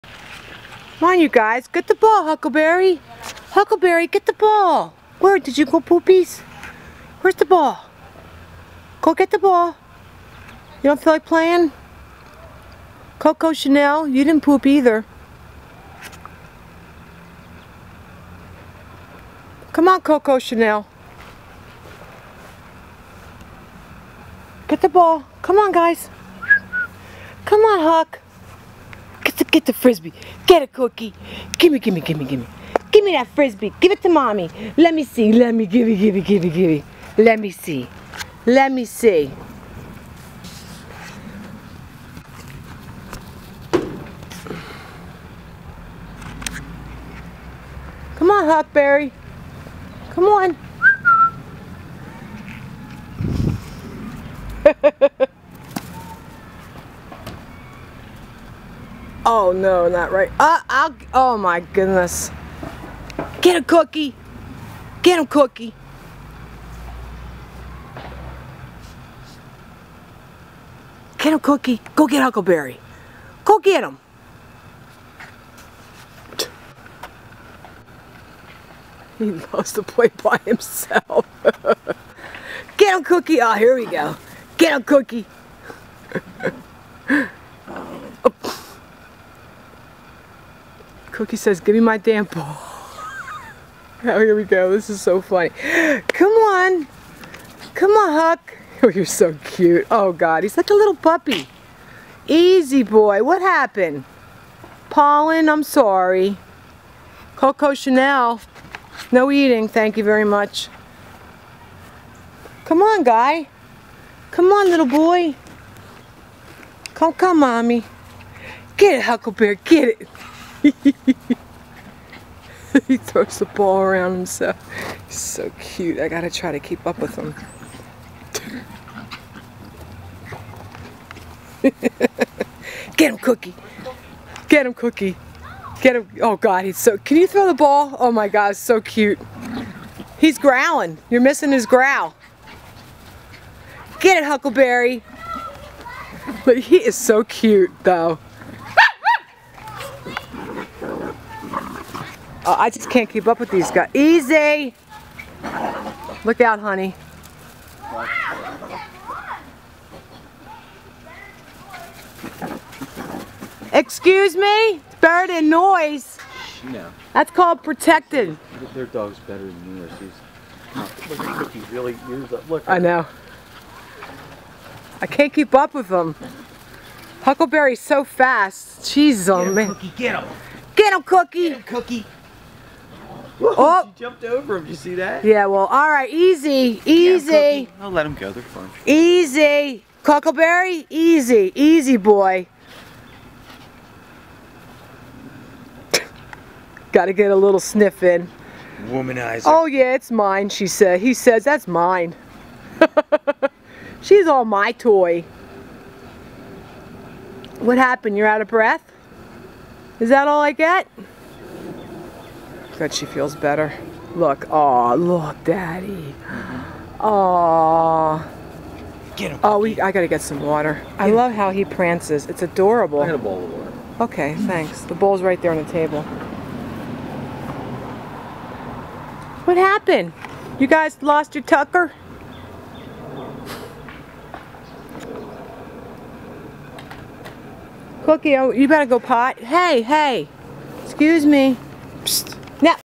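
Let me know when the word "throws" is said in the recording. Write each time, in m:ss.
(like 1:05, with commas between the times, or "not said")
2:02, 2:17.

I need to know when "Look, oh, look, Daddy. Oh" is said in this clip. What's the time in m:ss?
3:34.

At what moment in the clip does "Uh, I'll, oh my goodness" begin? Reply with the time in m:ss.
1:00.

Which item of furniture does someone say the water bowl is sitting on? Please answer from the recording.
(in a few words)
table.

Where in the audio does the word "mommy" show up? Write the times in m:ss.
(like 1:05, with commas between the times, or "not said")
0:34, 1:57.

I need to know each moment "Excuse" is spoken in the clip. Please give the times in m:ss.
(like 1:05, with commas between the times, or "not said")
2:43, 4:00.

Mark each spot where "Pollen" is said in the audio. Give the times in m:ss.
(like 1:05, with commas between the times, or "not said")
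1:44.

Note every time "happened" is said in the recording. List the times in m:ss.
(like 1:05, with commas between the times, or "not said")
1:43, 3:27, 3:49.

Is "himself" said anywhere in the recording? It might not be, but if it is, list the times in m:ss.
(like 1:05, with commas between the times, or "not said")
1:20, 2:04.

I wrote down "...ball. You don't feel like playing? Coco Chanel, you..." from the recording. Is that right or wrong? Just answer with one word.
right.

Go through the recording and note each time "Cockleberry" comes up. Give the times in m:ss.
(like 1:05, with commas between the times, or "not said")
3:10.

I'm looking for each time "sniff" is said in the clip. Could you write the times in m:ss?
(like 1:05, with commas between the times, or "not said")
3:17.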